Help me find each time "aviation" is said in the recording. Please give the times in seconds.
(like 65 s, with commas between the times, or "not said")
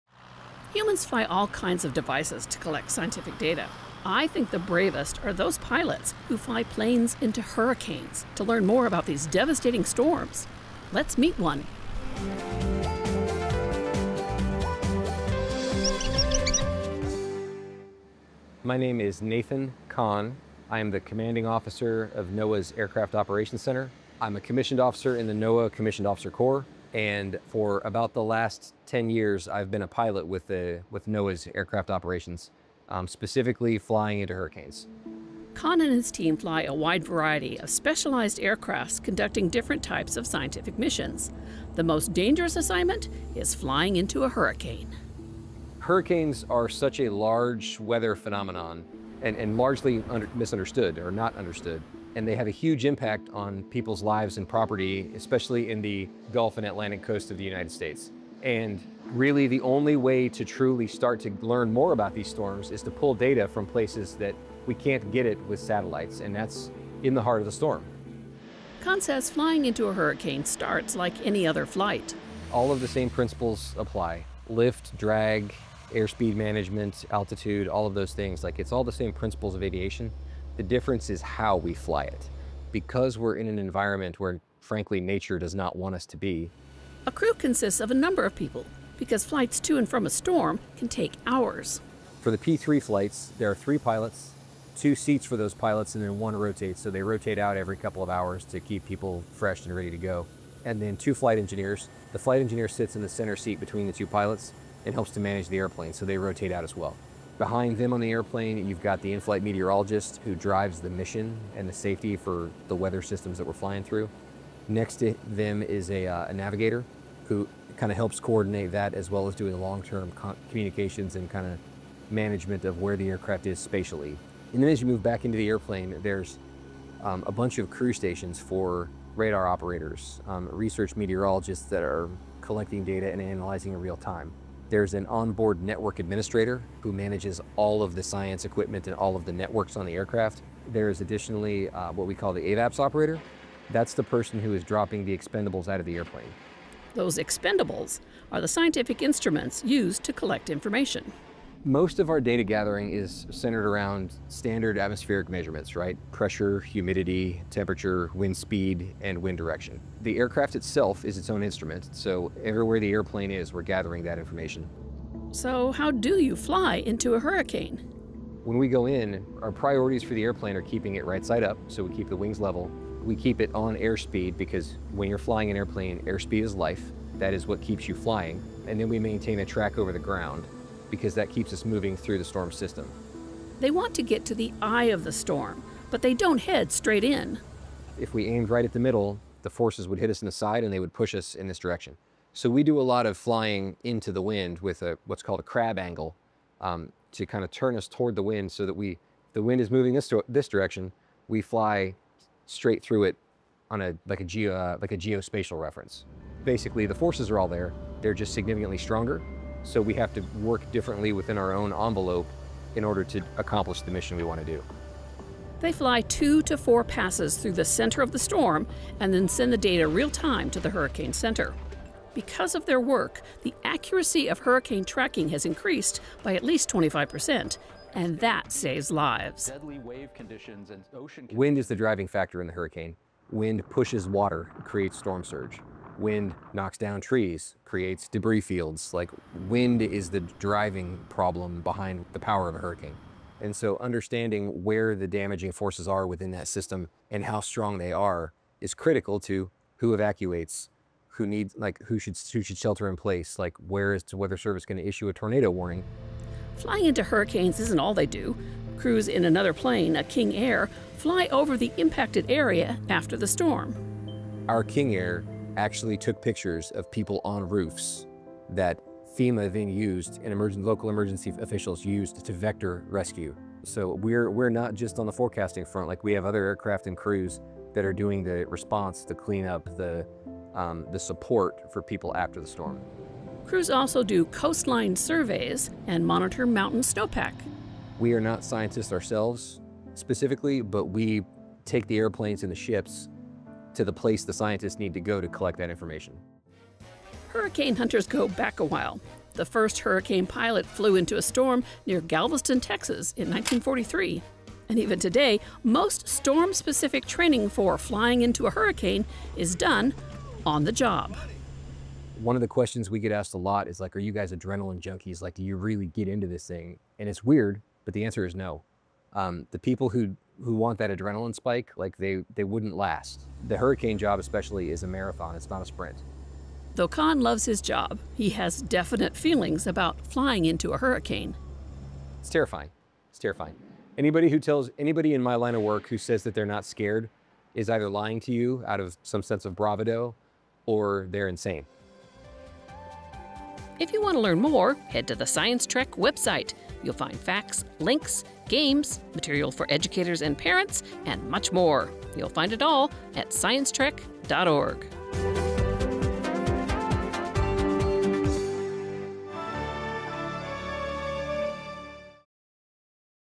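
79 s.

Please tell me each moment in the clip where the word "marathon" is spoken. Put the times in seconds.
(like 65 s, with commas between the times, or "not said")
324 s.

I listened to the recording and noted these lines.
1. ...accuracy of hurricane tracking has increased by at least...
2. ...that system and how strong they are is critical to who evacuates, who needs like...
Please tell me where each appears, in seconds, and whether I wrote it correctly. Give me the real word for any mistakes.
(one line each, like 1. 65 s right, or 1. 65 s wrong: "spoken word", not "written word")
1. 223 s right
2. 246 s right.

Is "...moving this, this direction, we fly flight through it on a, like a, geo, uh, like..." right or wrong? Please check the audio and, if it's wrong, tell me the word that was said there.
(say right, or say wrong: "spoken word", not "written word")
wrong: "straight", not "flight".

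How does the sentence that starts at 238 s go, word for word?
Like wind is the driving problem behind the power of a hurricane.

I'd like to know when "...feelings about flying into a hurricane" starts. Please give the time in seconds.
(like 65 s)
329 s.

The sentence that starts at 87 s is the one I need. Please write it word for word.
A crew consists of a number of people because flights to and from a storm can take hours.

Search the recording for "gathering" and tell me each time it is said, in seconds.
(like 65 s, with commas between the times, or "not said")
152 s, 163 s.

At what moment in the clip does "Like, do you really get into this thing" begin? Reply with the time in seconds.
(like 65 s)
315 s.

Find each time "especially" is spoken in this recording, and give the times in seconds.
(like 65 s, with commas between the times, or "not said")
55 s, 324 s.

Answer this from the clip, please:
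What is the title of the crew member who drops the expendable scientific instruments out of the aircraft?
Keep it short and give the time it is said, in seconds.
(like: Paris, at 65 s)
AVAPS operator, at 142 s.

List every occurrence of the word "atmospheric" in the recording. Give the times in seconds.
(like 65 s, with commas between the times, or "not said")
154 s.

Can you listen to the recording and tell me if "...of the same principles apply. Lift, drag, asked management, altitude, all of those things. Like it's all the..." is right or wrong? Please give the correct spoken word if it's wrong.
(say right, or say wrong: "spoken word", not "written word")
wrong: "airspeed", not "asked".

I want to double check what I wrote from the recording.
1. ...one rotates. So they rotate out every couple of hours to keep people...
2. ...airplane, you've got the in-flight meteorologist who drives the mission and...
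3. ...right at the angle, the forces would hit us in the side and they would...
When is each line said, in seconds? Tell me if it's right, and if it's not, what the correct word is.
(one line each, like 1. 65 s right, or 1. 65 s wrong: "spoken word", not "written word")
1. 96 s right
2. 108 s right
3. 188 s wrong: "middle", not "angle".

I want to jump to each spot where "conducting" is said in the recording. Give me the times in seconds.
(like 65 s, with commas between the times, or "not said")
39 s.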